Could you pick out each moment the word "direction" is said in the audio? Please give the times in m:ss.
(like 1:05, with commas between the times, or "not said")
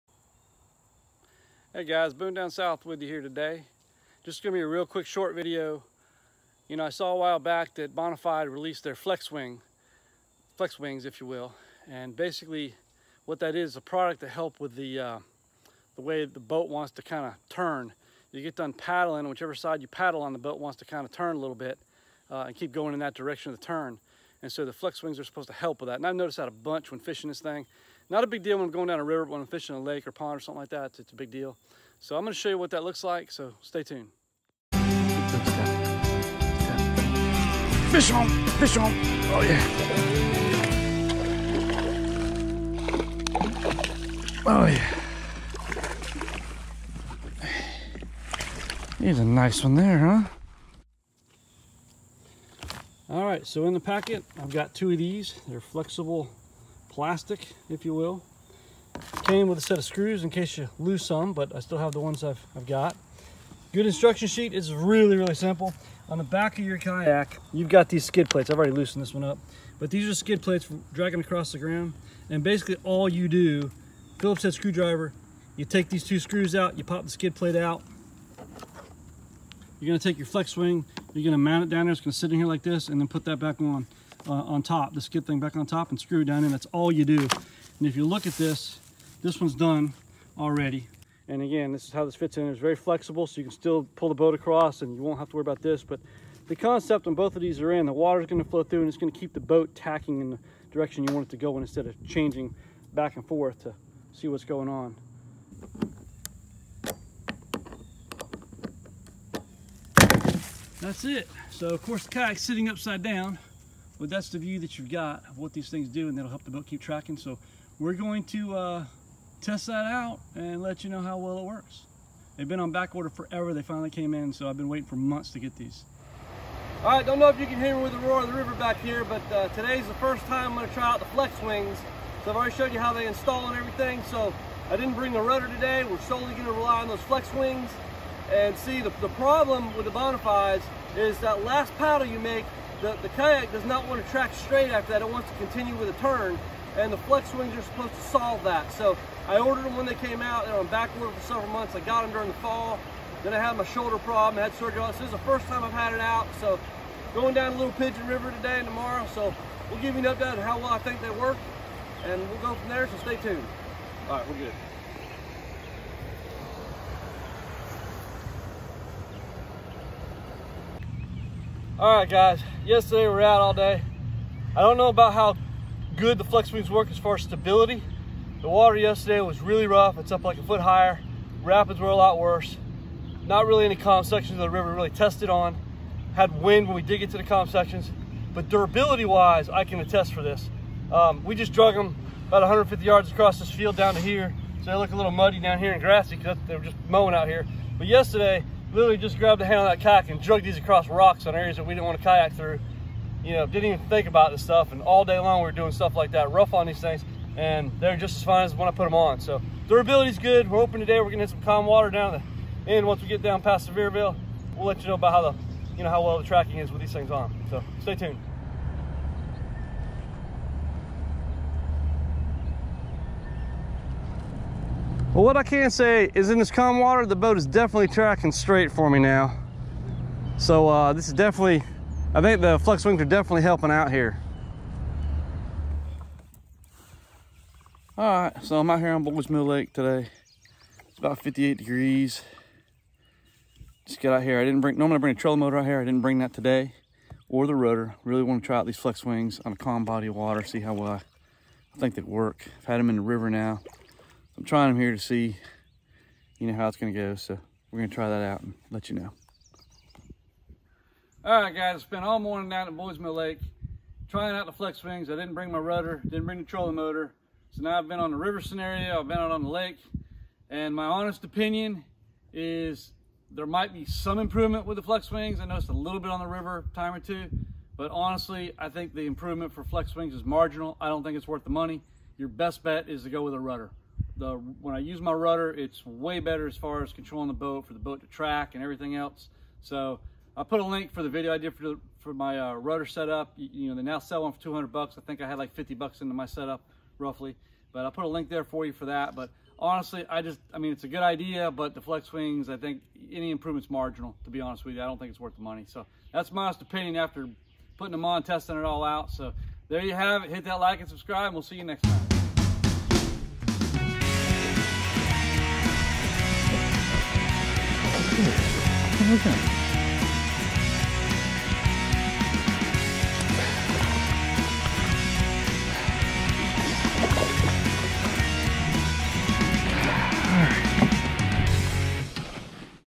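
0:23, 1:40.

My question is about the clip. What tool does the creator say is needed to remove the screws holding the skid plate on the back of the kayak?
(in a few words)
Phillips head screwdriver.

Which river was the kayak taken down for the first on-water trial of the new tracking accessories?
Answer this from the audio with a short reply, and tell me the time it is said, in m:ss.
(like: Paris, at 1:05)
Little Pigeon River, at 2:37.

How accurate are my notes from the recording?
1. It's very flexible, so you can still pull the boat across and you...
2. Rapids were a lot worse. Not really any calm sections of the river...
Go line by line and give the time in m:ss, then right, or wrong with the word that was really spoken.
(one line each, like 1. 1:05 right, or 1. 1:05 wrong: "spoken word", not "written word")
1. 1:32 right
2. 3:01 right.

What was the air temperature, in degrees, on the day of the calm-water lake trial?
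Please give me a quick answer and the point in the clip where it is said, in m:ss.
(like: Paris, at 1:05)
58 degrees, at 4:01.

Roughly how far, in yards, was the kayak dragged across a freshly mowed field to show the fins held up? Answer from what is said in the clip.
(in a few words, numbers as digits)
150 yards.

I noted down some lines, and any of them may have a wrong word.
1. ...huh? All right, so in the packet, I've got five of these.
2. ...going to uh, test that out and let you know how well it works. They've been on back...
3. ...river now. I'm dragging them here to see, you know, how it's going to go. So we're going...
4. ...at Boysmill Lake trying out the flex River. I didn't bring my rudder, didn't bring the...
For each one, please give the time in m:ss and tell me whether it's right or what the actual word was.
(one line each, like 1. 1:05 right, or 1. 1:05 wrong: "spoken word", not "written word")
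1. 0:49 wrong: "two", not "five"
2. 1:57 right
3. 4:13 wrong: "trying", not "dragging"
4. 4:22 wrong: "Wings", not "River".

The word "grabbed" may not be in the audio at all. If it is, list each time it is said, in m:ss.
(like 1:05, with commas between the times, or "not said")
3:19.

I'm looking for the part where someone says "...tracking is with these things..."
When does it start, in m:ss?
3:36.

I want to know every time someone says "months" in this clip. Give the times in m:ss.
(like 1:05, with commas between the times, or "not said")
2:04, 2:31.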